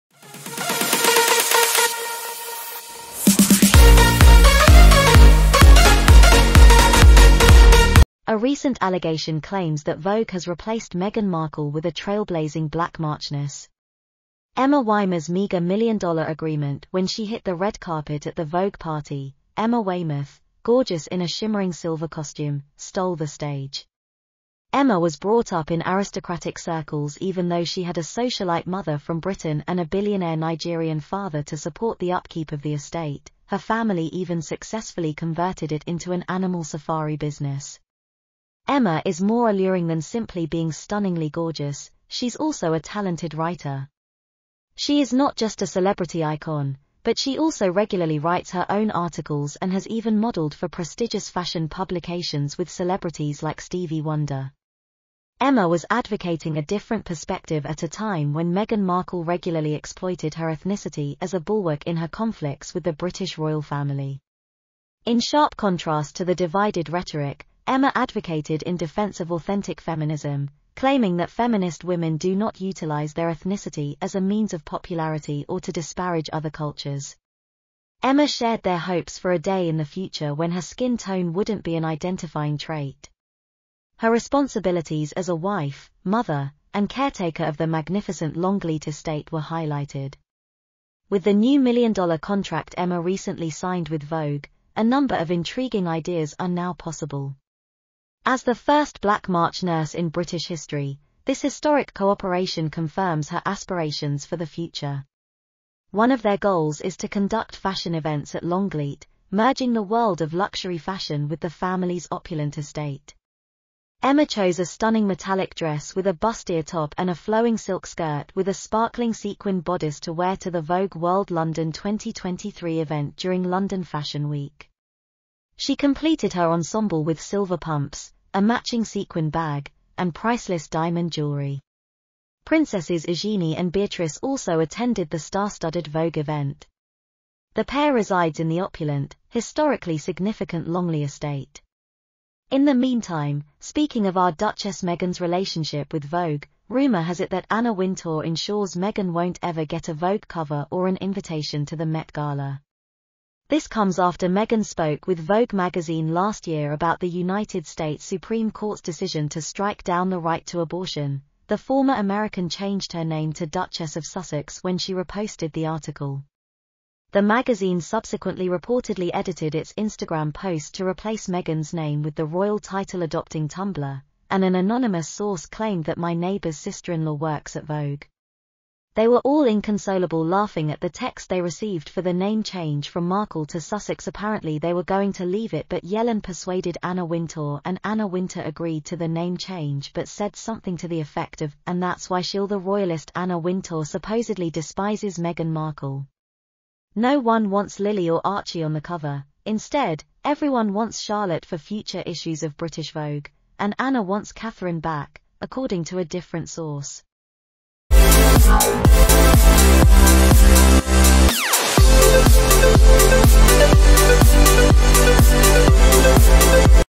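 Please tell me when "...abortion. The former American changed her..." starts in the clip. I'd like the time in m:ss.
2:40.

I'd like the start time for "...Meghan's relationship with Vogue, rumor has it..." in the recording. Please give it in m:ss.
2:24.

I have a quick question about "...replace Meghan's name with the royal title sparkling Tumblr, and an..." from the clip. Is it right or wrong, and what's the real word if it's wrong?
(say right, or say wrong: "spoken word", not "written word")
wrong: "adopting", not "sparkling".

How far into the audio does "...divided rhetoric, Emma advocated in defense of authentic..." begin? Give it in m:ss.
1:06.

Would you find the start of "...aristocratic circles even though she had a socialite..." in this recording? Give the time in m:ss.
0:25.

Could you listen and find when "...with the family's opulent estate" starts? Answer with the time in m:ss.
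1:51.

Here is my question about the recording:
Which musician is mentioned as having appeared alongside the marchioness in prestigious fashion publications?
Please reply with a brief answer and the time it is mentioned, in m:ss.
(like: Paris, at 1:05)
Stevie Wonder, at 0:53.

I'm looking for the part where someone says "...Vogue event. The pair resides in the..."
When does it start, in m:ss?
2:15.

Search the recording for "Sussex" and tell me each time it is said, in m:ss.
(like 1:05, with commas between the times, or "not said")
2:44, 3:03.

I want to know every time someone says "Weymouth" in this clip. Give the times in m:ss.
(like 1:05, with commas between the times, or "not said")
0:14, 0:19.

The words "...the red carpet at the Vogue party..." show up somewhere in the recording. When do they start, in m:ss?
0:17.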